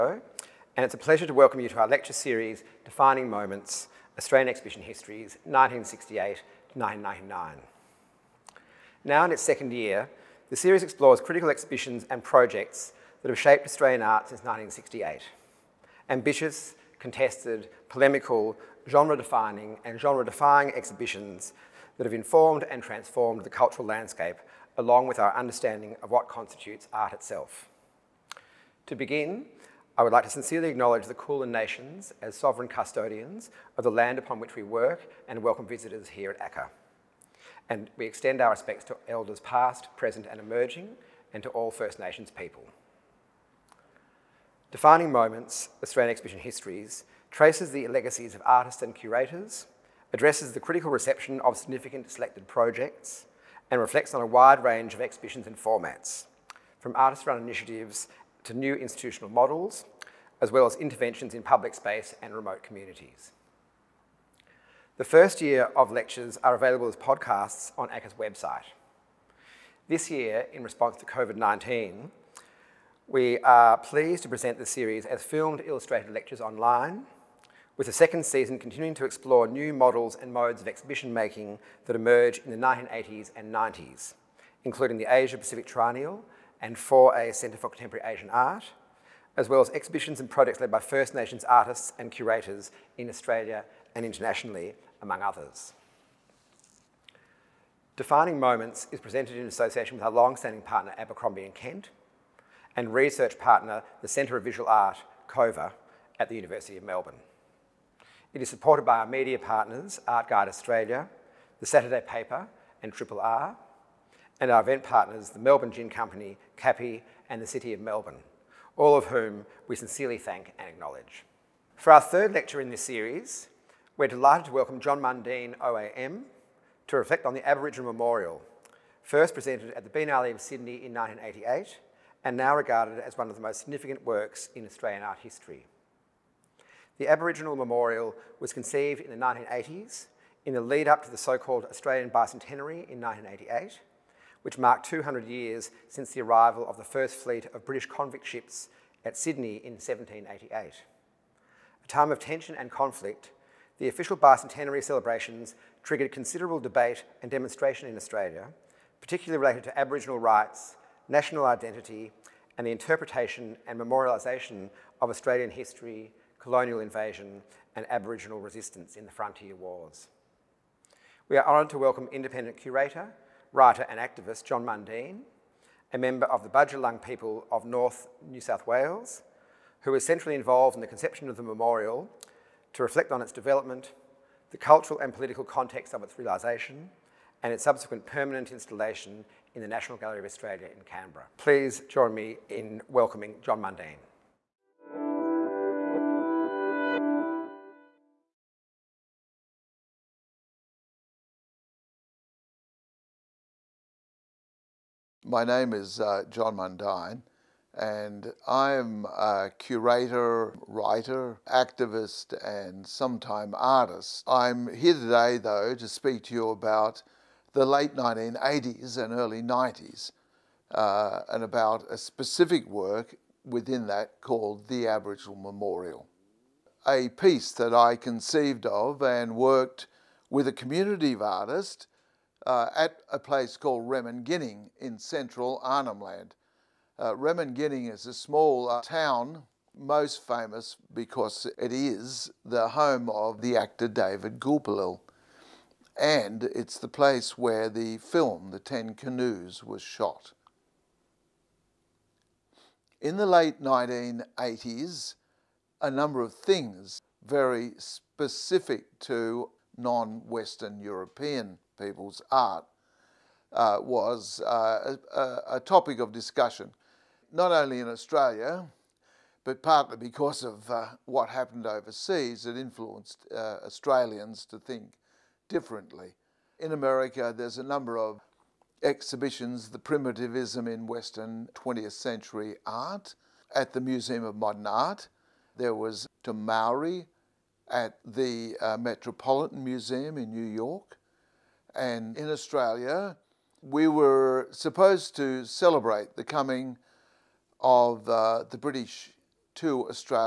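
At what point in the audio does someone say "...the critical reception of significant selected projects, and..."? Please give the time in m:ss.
0:50.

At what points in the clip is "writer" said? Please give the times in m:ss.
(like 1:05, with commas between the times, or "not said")
2:53, 3:30.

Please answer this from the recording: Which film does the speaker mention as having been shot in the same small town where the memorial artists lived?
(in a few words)
The Ten Canoes.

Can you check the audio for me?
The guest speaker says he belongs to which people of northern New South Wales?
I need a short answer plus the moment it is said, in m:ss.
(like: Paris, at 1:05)
Bandjalung, at 2:56.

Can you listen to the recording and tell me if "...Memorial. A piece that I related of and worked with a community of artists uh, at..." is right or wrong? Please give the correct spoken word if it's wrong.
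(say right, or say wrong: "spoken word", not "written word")
wrong: "conceived", not "related".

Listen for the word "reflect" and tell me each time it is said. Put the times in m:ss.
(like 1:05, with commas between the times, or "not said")
0:53, 2:06, 3:02.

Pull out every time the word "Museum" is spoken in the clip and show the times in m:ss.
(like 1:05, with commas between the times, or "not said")
4:43, 4:49.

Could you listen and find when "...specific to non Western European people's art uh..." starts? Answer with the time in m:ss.
4:17.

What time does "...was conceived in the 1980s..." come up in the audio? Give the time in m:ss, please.
2:18.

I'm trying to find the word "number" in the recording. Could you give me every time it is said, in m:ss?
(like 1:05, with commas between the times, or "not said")
4:15, 4:37.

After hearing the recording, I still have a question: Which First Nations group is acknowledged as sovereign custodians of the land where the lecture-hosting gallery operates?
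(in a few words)
Kulin Nations.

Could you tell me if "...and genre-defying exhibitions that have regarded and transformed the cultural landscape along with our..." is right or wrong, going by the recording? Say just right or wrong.
wrong.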